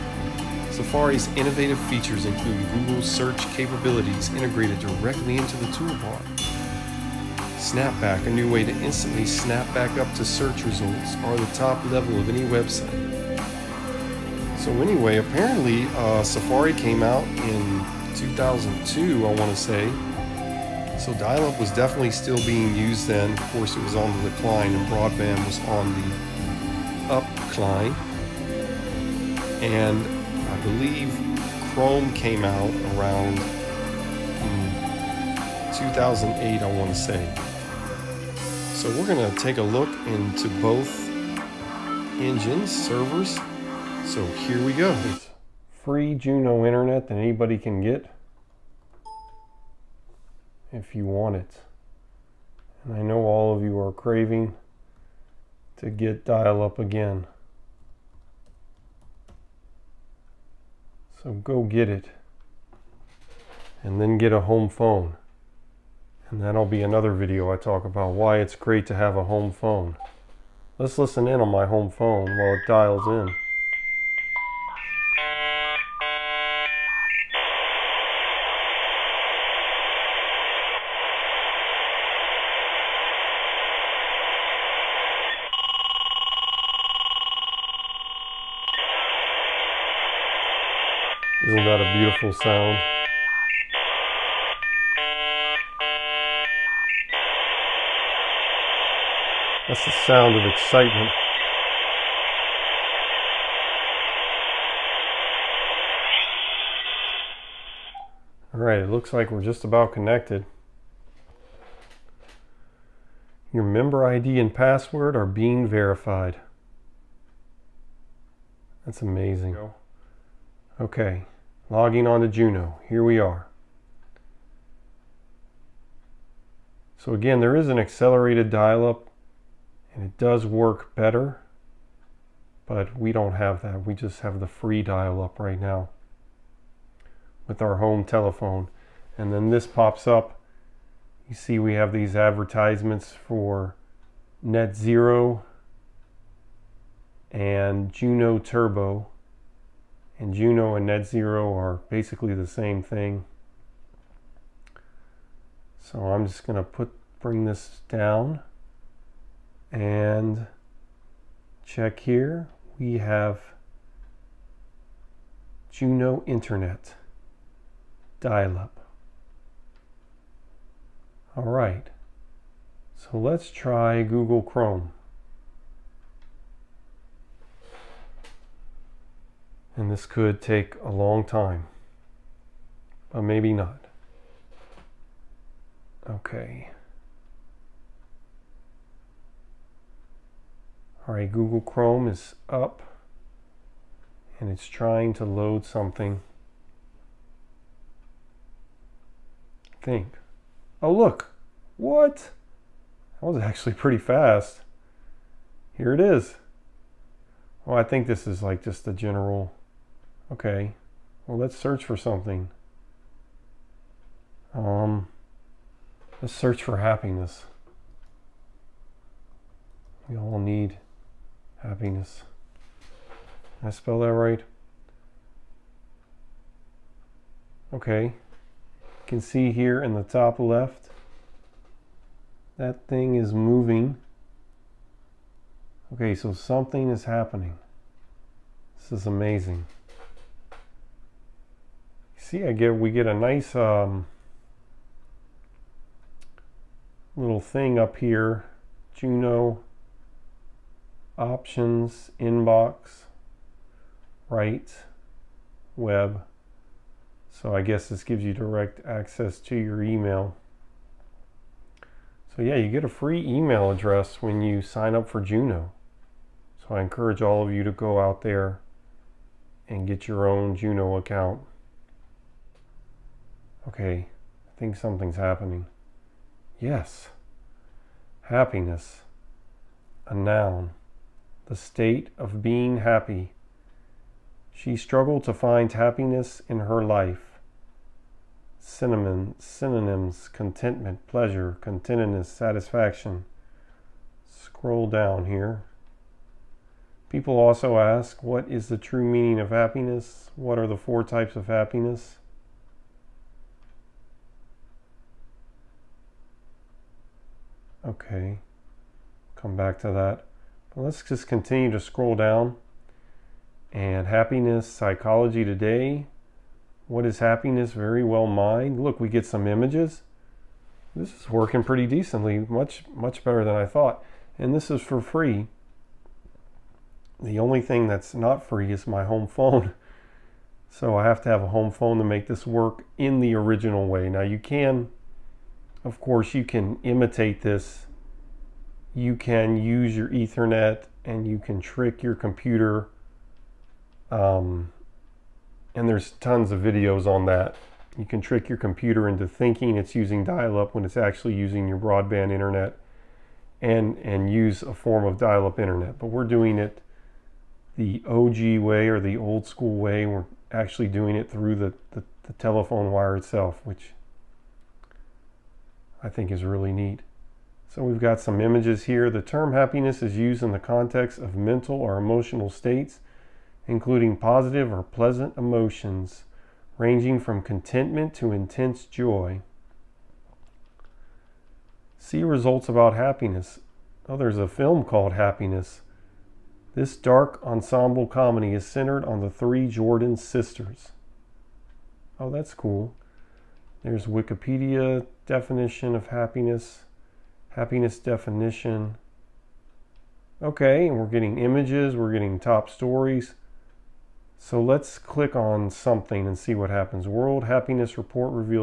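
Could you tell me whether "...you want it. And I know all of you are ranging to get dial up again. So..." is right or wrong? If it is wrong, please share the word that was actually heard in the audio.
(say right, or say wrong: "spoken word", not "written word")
wrong: "craving", not "ranging".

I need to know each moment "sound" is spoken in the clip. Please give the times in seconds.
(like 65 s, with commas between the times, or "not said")
92 s, 100 s.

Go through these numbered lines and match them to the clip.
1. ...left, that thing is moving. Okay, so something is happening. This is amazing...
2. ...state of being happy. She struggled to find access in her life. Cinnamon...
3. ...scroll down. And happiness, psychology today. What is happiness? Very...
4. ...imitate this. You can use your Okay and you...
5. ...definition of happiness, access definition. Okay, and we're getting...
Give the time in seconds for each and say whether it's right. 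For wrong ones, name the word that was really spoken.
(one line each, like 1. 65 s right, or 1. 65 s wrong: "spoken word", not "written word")
1. 230 s right
2. 281 s wrong: "happiness", not "access"
3. 311 s right
4. 336 s wrong: "Ethernet", not "Okay"
5. 395 s wrong: "happiness", not "access".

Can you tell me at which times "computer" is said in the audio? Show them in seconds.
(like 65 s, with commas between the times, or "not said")
342 s, 348 s.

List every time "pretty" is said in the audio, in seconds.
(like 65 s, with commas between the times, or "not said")
203 s, 321 s.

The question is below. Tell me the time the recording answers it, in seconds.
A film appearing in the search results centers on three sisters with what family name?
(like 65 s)
389 s.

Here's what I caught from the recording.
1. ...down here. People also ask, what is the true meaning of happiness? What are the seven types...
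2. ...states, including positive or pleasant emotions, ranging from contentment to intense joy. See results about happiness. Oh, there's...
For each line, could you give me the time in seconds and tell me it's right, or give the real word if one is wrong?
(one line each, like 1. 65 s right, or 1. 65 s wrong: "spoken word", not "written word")
1. 294 s wrong: "four", not "seven"
2. 372 s right.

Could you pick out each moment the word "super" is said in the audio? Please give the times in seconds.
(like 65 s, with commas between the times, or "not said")
not said.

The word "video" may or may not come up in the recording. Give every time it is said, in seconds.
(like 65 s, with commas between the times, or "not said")
67 s, 346 s.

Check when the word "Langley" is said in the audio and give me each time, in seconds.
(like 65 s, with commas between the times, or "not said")
not said.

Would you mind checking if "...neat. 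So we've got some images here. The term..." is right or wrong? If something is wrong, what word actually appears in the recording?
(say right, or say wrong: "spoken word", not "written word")
right.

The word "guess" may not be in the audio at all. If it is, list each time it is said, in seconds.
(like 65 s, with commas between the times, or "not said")
257 s.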